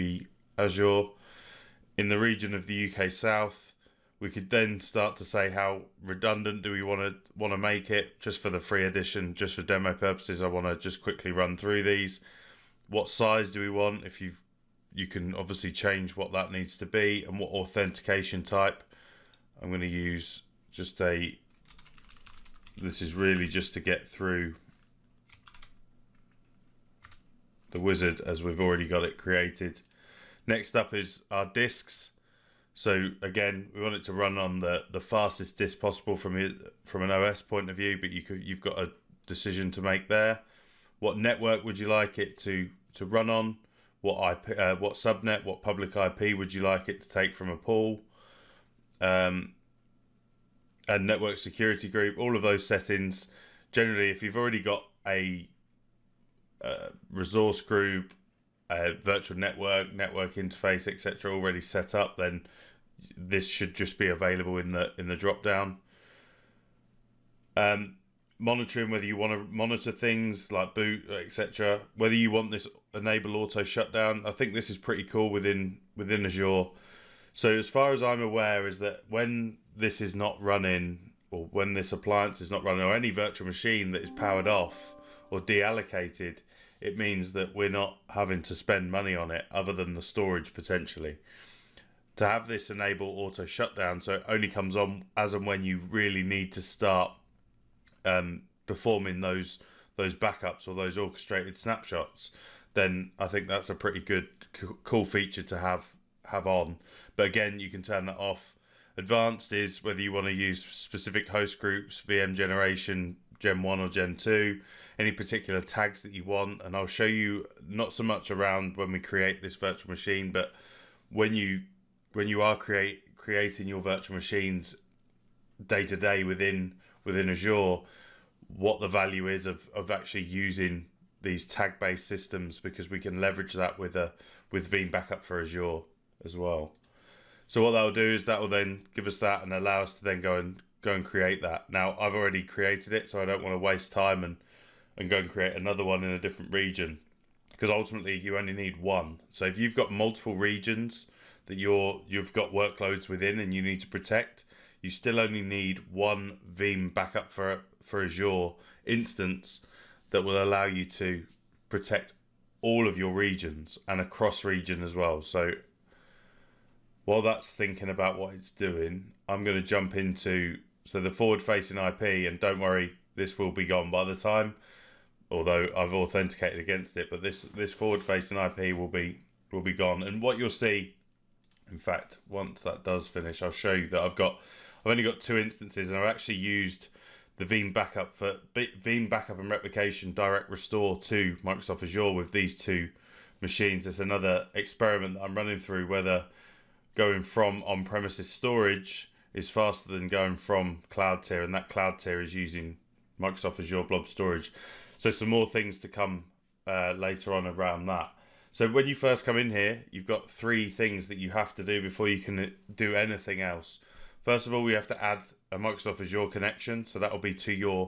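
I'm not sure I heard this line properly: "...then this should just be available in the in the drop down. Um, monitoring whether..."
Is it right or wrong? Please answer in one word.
right.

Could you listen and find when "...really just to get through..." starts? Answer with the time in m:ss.
0:23.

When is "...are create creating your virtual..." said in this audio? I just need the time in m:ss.
2:02.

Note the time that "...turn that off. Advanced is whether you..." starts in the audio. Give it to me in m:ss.
1:47.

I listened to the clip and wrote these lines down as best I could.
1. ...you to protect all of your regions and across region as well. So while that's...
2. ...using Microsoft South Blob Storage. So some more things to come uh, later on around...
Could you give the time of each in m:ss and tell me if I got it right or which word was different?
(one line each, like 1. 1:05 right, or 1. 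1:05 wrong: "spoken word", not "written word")
1. 2:40 right
2. 3:22 wrong: "Azure", not "South".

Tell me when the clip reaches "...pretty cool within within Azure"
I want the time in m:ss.
1:14.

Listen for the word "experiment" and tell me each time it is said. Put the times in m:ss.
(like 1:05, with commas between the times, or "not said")
3:14.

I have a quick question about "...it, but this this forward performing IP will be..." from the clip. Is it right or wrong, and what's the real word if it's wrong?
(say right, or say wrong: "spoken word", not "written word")
wrong: "facing", not "performing".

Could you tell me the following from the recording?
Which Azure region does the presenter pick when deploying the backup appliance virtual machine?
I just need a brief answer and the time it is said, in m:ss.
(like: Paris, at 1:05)
UK South, at 0:02.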